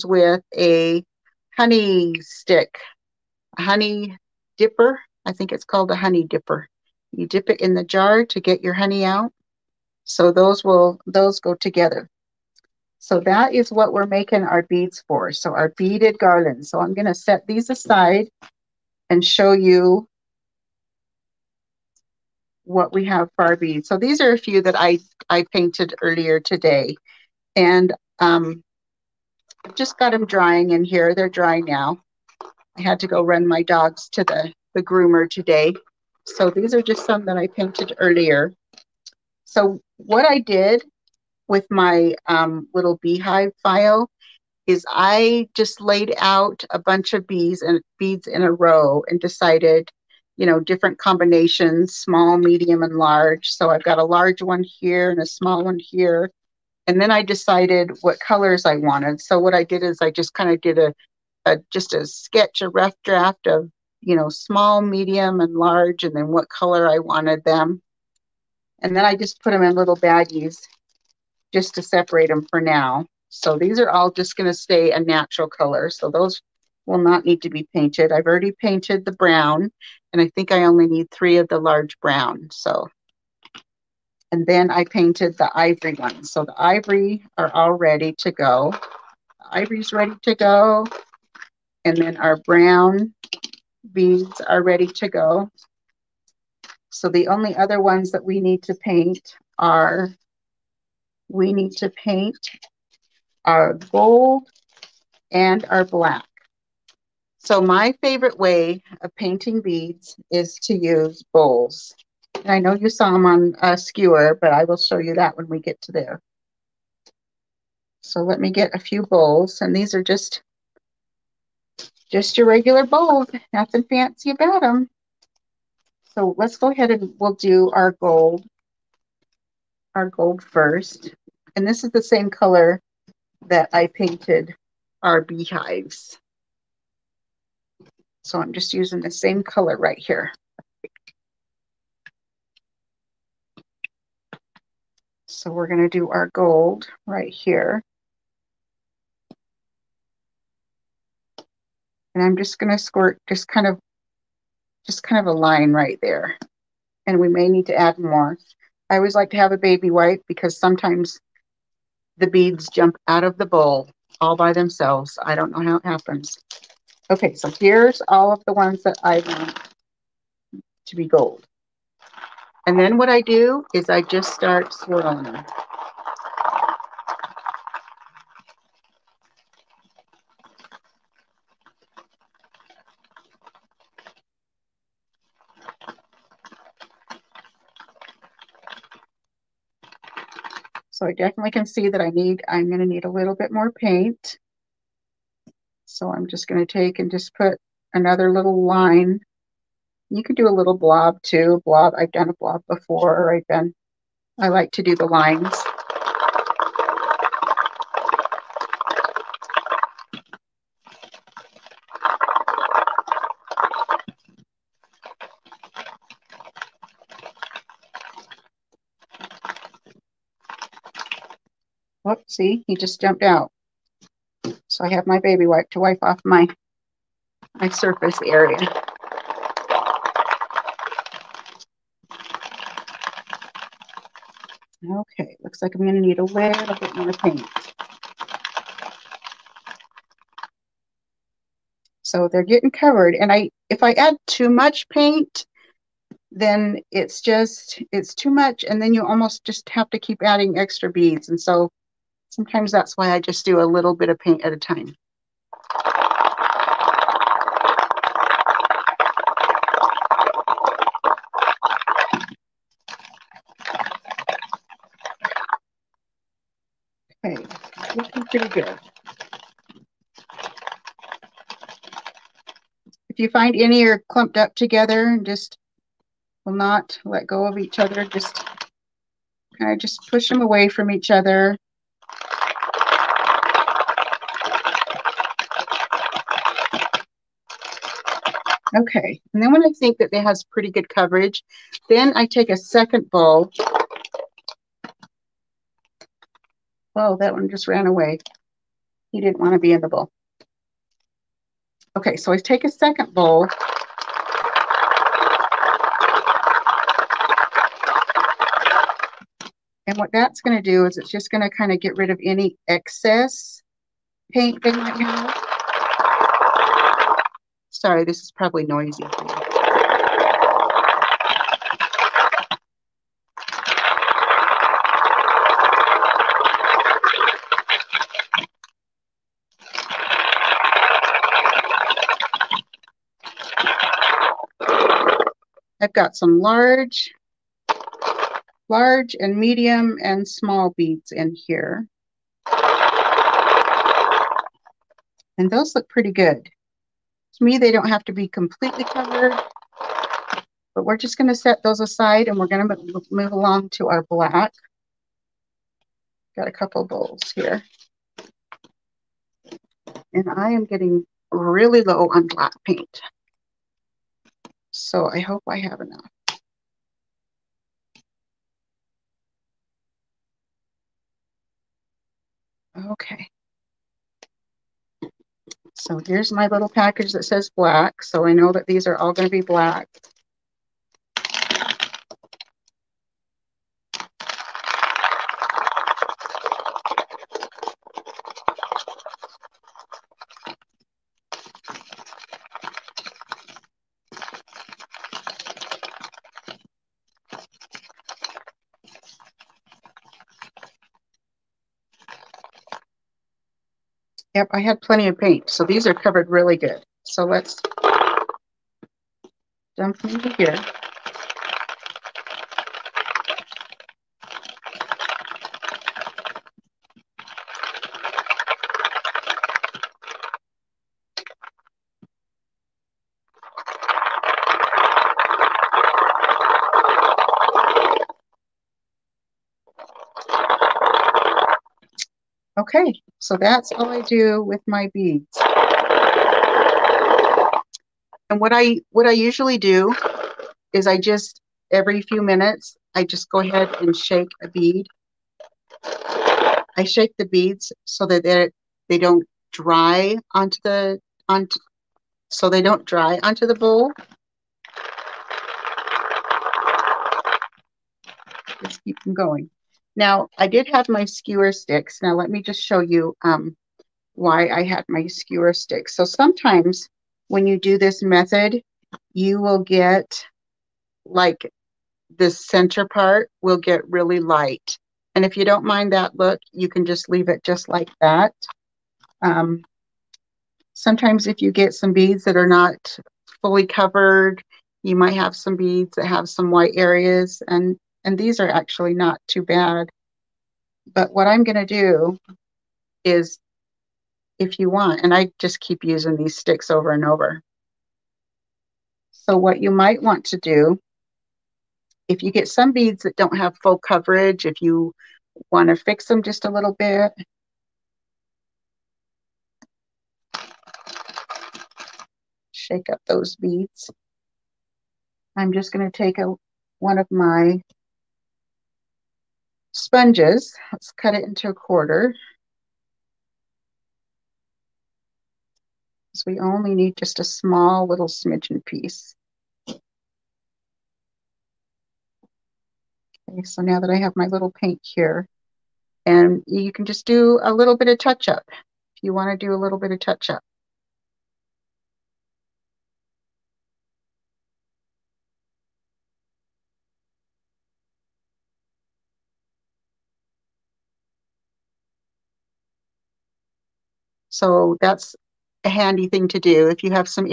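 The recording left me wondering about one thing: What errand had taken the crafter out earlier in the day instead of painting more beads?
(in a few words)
groomer.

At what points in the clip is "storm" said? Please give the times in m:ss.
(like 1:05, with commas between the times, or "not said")
not said.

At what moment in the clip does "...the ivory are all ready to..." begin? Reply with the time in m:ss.
1:26.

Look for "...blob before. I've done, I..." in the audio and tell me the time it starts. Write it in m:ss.
3:22.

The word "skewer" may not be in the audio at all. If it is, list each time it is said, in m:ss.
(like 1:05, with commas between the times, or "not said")
1:53, 7:41, 7:45.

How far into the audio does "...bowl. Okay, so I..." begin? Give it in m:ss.
4:59.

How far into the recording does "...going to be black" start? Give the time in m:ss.
6:19.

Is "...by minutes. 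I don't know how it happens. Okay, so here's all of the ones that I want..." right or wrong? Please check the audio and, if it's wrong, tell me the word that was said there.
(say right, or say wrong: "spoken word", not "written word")
wrong: "themselves", not "minutes".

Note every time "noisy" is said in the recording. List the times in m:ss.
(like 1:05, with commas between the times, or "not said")
5:18.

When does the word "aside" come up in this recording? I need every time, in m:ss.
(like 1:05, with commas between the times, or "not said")
0:17, 5:51.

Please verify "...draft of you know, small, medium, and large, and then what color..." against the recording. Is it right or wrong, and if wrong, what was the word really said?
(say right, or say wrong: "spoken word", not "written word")
right.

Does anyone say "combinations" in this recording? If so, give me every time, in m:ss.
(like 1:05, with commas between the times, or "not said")
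0:50.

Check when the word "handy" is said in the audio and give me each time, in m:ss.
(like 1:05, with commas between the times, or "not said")
9:15.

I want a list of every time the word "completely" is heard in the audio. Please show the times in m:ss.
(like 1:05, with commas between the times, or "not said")
5:48.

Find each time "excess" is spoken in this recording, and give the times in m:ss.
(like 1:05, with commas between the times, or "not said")
5:12.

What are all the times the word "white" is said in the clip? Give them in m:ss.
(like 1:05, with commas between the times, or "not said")
8:06.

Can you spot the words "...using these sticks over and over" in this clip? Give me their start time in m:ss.
8:15.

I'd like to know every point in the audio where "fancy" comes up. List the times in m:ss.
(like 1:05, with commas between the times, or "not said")
2:03.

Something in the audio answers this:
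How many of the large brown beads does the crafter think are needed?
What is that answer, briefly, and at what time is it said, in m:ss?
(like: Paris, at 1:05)
3, at 1:21.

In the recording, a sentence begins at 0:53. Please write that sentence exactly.
So I've got a large one here and a small one here.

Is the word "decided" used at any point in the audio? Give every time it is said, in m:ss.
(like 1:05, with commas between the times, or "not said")
0:49, 0:57.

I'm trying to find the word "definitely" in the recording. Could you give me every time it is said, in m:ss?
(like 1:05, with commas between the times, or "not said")
3:11.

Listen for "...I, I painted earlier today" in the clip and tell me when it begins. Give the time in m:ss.
0:24.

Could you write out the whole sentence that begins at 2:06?
So let's go ahead and we'll do our gold, our gold first.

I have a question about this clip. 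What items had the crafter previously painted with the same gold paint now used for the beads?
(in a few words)
beehives.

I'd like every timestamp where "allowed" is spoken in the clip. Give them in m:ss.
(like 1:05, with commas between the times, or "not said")
not said.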